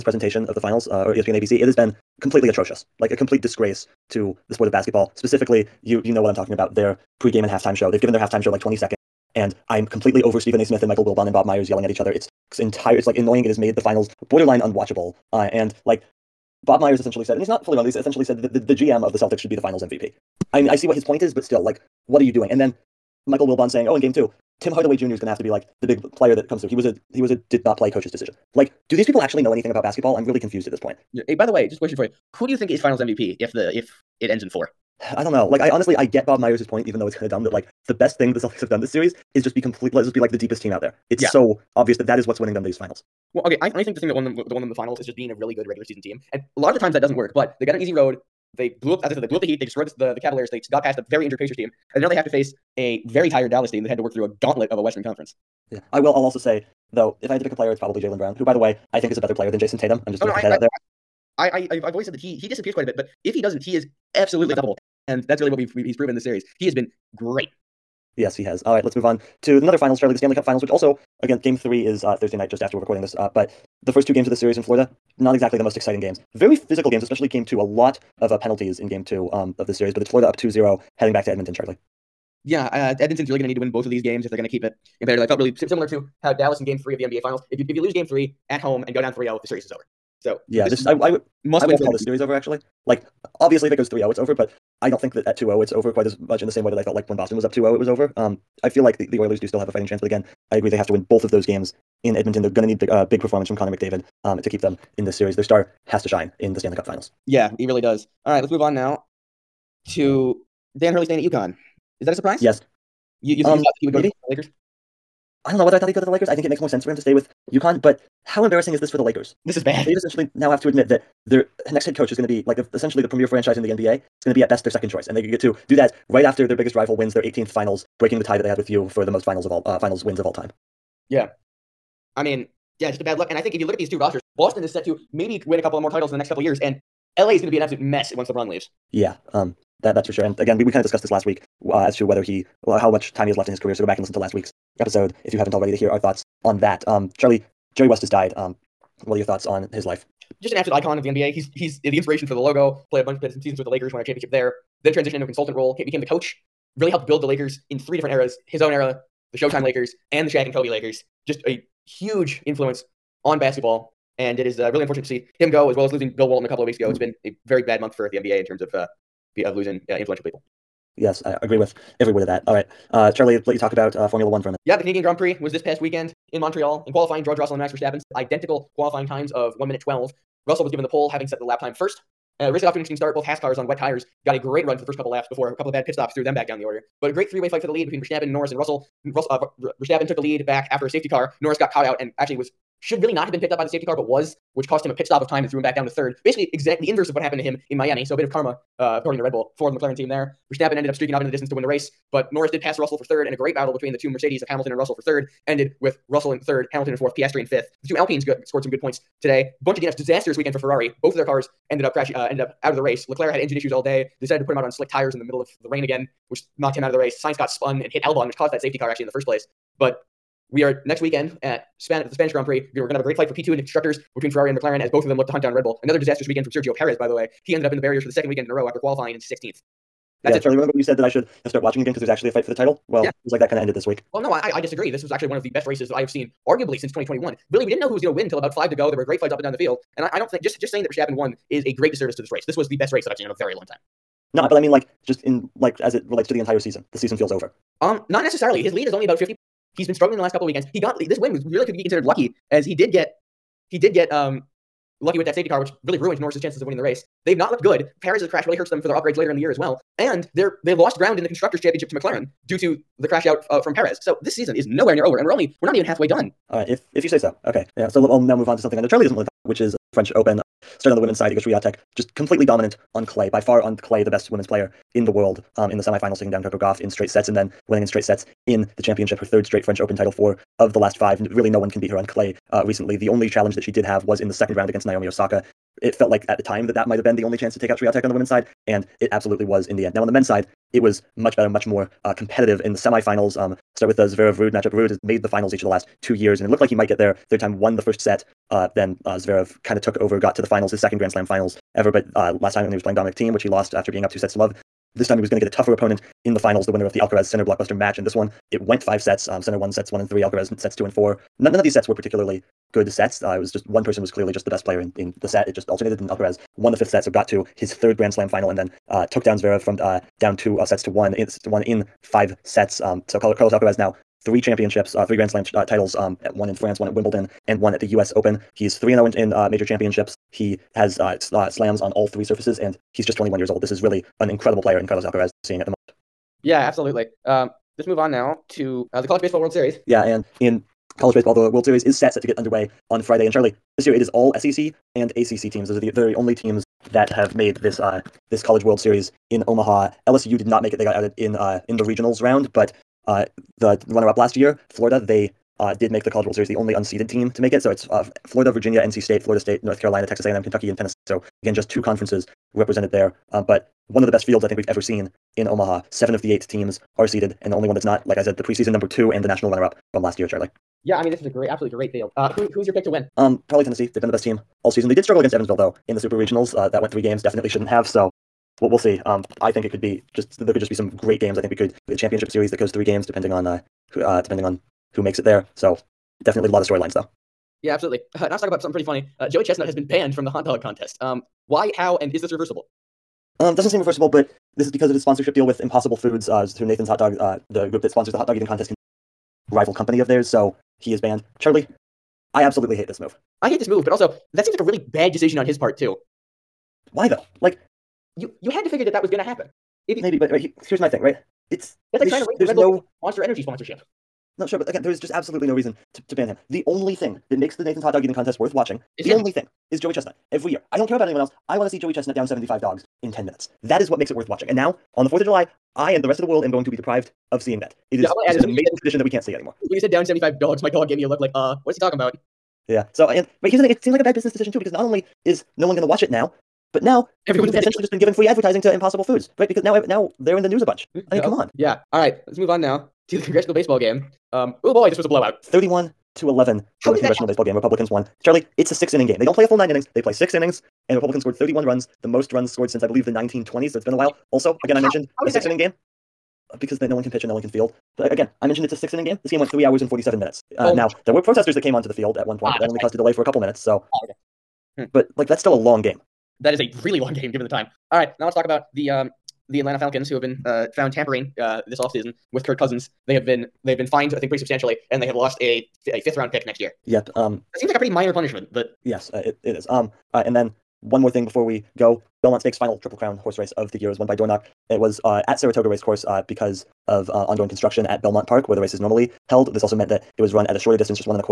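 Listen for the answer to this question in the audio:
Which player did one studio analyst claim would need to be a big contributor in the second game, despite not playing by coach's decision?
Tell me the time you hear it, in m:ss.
0:24.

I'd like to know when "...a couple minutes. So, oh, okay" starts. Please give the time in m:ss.
7:43.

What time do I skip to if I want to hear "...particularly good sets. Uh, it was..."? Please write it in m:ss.
5:11.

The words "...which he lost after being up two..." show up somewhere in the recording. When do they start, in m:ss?
5:03.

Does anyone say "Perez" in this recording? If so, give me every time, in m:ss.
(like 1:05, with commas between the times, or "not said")
3:46, 4:18, 4:23.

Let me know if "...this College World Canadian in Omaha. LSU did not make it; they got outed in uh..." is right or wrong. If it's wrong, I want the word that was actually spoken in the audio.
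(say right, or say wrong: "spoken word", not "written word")
wrong: "Series", not "Canadian".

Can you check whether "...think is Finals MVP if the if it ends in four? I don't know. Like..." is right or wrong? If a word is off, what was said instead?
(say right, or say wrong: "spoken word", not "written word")
right.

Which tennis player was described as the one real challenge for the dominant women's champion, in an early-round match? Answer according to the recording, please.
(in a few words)
Naomi Osaka.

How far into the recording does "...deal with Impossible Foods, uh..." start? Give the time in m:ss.
6:35.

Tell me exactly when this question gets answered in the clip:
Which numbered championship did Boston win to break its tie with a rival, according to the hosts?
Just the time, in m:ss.
2:07.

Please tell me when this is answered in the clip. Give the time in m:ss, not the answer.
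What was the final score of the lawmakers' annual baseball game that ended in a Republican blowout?
7:25.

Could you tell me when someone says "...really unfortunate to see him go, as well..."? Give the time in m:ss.
2:44.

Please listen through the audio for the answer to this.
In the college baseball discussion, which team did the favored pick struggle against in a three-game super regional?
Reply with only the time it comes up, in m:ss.
6:15.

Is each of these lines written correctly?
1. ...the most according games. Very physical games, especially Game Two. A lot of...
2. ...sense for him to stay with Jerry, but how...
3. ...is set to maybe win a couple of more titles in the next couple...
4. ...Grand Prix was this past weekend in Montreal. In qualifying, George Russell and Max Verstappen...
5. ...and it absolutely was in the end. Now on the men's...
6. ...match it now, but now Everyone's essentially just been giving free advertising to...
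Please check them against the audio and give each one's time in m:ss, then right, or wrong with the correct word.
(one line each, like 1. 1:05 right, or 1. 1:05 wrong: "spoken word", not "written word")
1. 1:15 wrong: "exciting", not "according"
2. 1:56 wrong: "UConn", not "Jerry"
3. 2:14 right
4. 2:55 right
5. 4:48 right
6. 7:15 wrong: "watch", not "match".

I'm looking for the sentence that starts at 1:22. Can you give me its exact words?
Yeah, uh, Edmonton's really going to need to win both of these games if they're going to keep it competitive.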